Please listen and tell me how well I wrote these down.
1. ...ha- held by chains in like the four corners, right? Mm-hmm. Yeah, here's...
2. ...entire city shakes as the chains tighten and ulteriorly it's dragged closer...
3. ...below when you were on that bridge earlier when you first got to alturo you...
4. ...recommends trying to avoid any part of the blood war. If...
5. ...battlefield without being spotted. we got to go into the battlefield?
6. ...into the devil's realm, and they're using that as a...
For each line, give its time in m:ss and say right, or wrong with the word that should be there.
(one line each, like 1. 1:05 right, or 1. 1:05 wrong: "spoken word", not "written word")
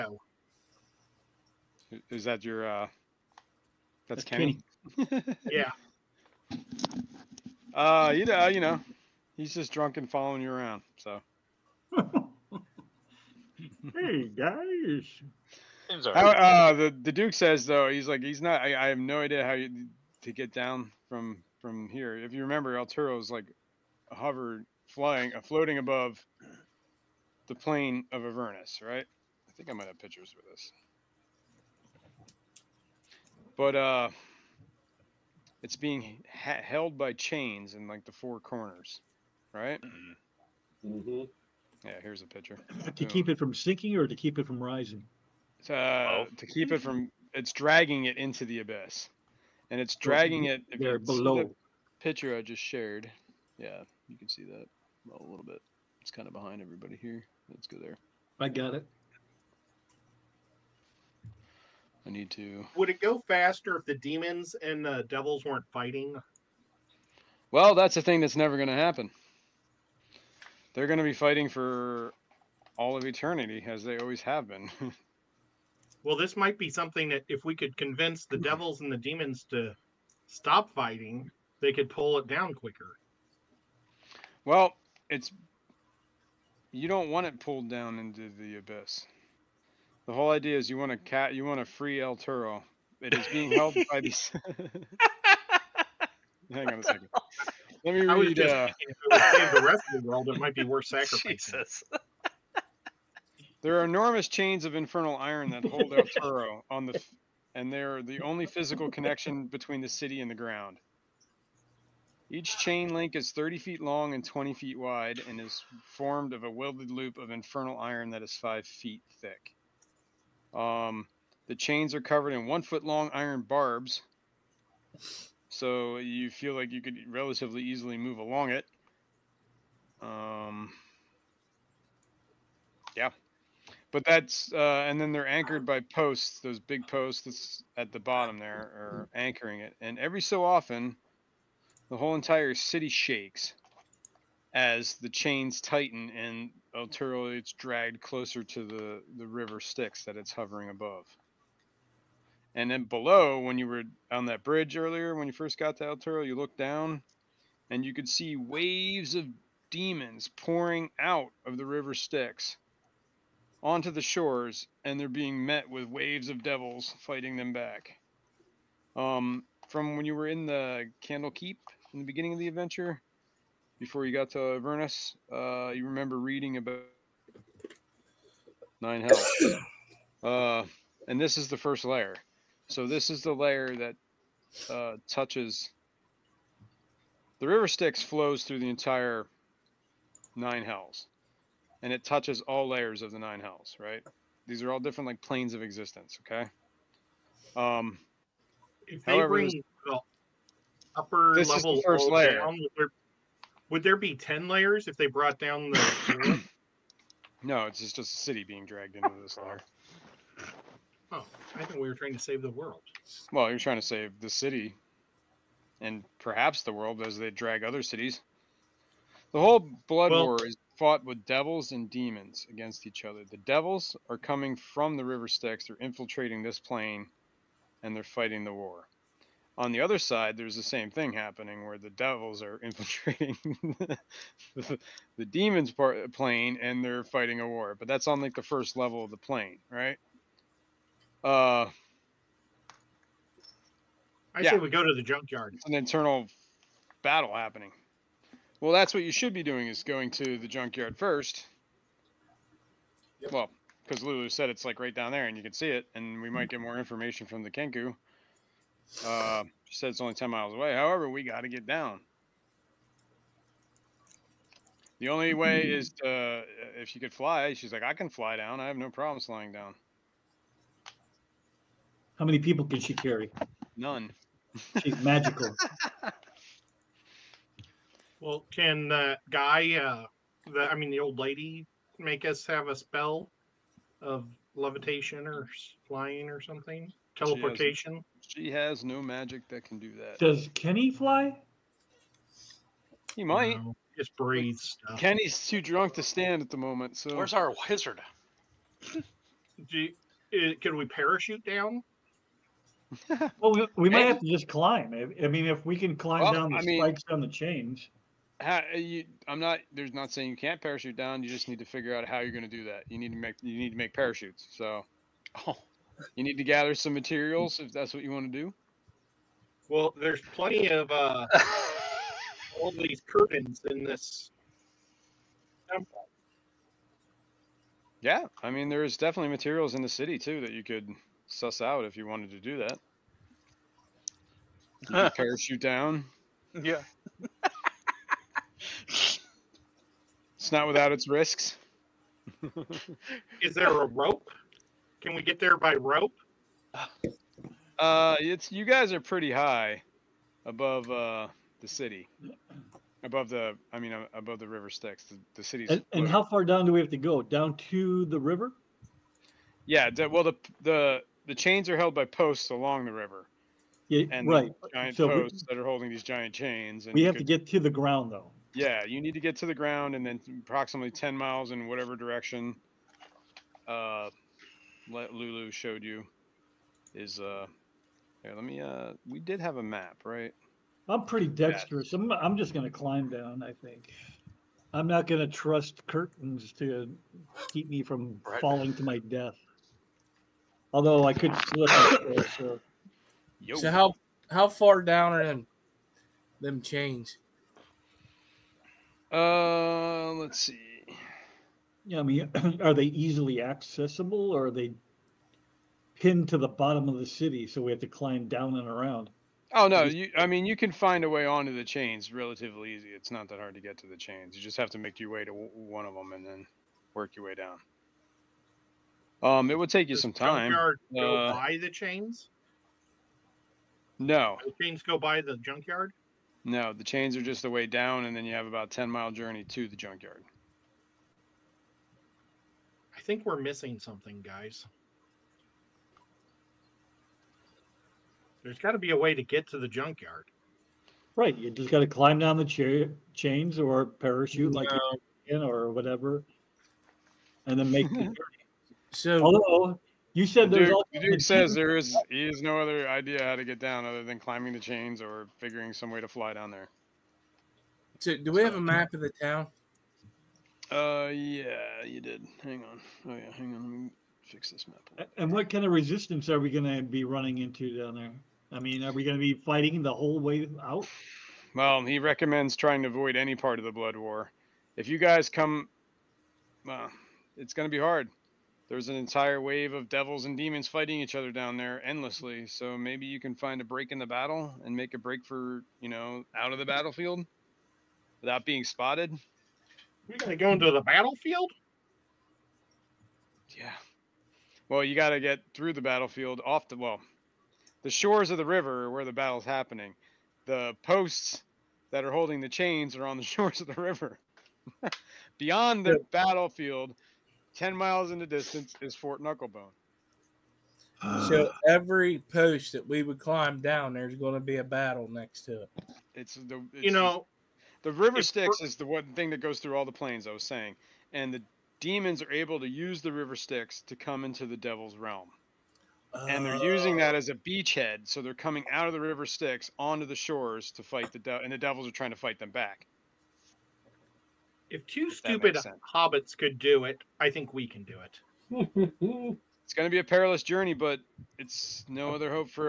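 1. 0:36 right
2. 2:22 right
3. 2:32 right
4. 7:51 right
5. 8:06 right
6. 8:44 right.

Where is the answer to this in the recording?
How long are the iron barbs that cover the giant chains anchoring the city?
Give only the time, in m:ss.
2:02.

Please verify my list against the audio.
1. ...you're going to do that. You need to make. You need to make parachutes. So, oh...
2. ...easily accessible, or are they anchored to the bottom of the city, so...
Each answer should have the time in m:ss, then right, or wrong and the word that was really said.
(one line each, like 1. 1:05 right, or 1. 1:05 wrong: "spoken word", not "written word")
1. 5:12 right
2. 6:42 wrong: "pinned", not "anchored".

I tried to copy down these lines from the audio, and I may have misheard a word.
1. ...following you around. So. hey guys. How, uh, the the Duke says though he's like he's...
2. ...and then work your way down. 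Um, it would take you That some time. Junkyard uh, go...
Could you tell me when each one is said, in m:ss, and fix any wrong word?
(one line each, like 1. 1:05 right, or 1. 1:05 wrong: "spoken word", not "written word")
1. 0:10 right
2. 6:56 wrong: "Does", not "That".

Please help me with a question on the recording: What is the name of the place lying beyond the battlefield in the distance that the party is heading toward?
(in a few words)
Fort Knucklebone.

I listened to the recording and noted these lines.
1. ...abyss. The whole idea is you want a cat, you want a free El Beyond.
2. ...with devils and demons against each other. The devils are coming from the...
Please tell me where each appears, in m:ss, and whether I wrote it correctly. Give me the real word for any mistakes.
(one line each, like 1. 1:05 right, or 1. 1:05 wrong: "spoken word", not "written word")
1. 1:28 wrong: "Toro", not "Beyond"
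2. 3:41 right.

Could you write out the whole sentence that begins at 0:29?
I think I might have pictures with this.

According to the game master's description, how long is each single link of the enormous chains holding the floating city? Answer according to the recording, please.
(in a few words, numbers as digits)
30 feet.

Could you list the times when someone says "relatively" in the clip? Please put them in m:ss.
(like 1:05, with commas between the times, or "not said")
2:07, 6:52.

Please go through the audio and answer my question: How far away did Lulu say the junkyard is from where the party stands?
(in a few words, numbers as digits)
10 miles.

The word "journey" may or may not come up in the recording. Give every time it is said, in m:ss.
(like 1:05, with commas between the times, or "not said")
7:09, 7:28, 9:00.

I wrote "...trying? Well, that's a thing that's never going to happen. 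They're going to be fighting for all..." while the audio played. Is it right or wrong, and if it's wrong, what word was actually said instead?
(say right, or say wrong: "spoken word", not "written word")
wrong: "fighting", not "trying".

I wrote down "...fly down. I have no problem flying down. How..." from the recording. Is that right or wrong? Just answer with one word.
right.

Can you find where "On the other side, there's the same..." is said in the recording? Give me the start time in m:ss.
3:49.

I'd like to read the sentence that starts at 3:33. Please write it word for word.
Well, you're trying to save the city and perhaps the world as they drag other cities.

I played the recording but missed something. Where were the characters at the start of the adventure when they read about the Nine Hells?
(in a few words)
Candlekeep.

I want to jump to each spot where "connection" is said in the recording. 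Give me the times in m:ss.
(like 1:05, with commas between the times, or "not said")
1:48.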